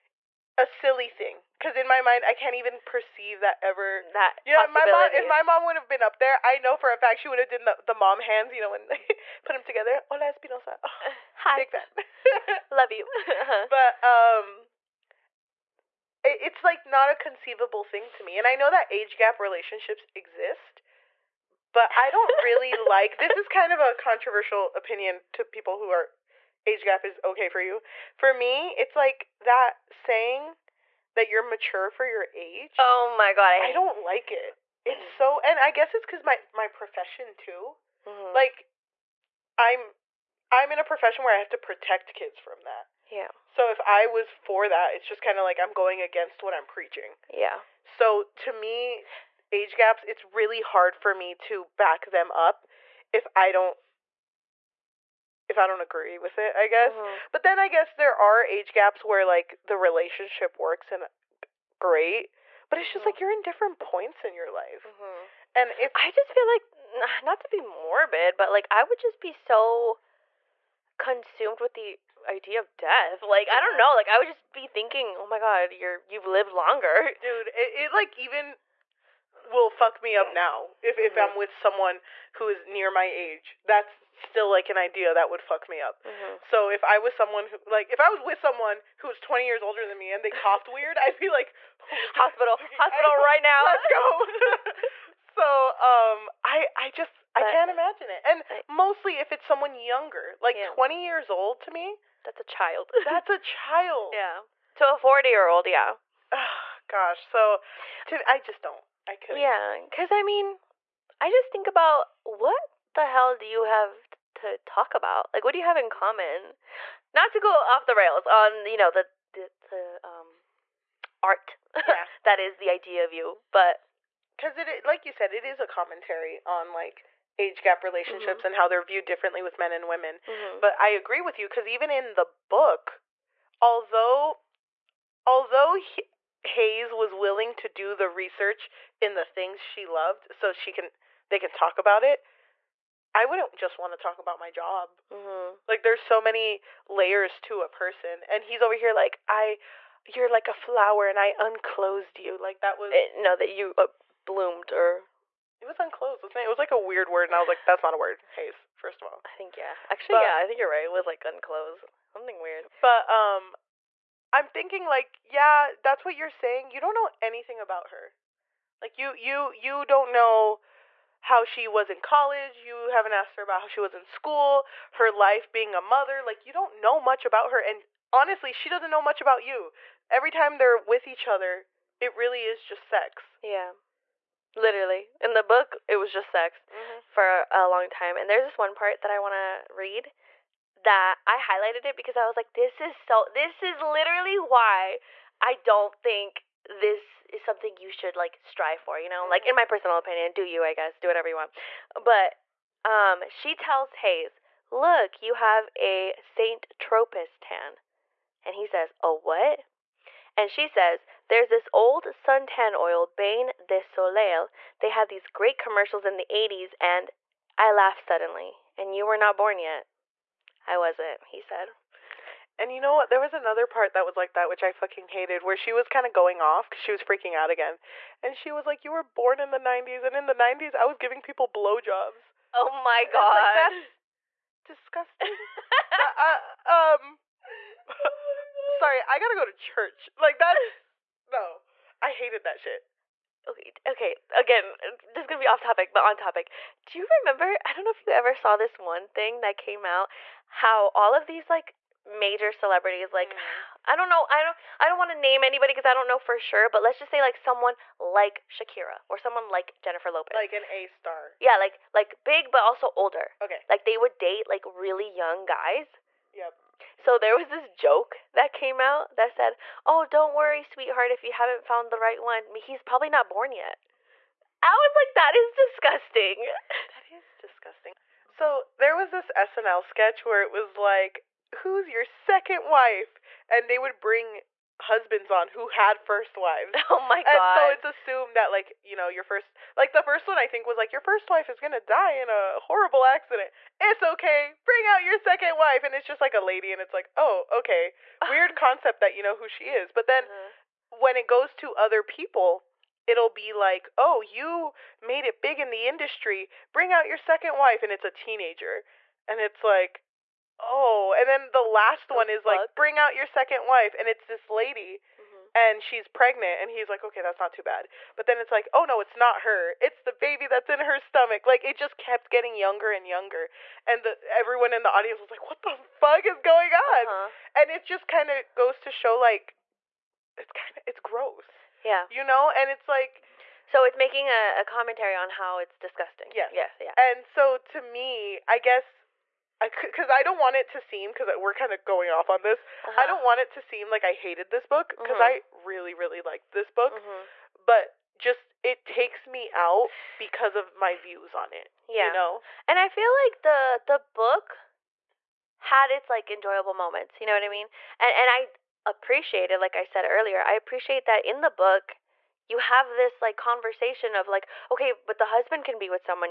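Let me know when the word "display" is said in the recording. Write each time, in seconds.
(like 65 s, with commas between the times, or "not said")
not said.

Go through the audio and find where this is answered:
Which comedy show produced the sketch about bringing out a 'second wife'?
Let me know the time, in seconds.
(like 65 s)
279 s.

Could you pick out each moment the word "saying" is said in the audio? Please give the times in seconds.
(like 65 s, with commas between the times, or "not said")
29 s, 166 s.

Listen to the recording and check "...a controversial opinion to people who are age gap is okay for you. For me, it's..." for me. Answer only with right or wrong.
right.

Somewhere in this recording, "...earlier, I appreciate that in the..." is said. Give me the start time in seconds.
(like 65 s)
360 s.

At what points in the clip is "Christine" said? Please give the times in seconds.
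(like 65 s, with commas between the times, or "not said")
not said.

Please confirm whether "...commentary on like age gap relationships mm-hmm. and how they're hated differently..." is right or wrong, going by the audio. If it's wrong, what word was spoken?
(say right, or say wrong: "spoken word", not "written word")
wrong: "viewed", not "hated".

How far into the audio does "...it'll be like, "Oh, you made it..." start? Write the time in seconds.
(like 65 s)
303 s.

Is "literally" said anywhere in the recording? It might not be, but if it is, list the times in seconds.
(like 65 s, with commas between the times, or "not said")
184 s, 193 s.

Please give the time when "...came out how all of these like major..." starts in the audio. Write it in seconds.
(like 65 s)
249 s.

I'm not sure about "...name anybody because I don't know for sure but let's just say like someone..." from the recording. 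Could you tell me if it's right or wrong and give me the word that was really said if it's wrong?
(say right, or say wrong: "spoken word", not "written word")
right.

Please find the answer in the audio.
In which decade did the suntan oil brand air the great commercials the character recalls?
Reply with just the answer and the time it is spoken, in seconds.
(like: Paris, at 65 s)
80s, at 216 s.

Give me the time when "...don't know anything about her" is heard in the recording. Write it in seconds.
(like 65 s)
166 s.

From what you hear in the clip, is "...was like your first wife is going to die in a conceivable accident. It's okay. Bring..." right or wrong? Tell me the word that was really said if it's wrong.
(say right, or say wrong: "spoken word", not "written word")
wrong: "horrible", not "conceivable".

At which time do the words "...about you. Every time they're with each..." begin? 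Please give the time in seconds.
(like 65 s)
179 s.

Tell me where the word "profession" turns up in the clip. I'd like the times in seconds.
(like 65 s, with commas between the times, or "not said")
36 s, 40 s.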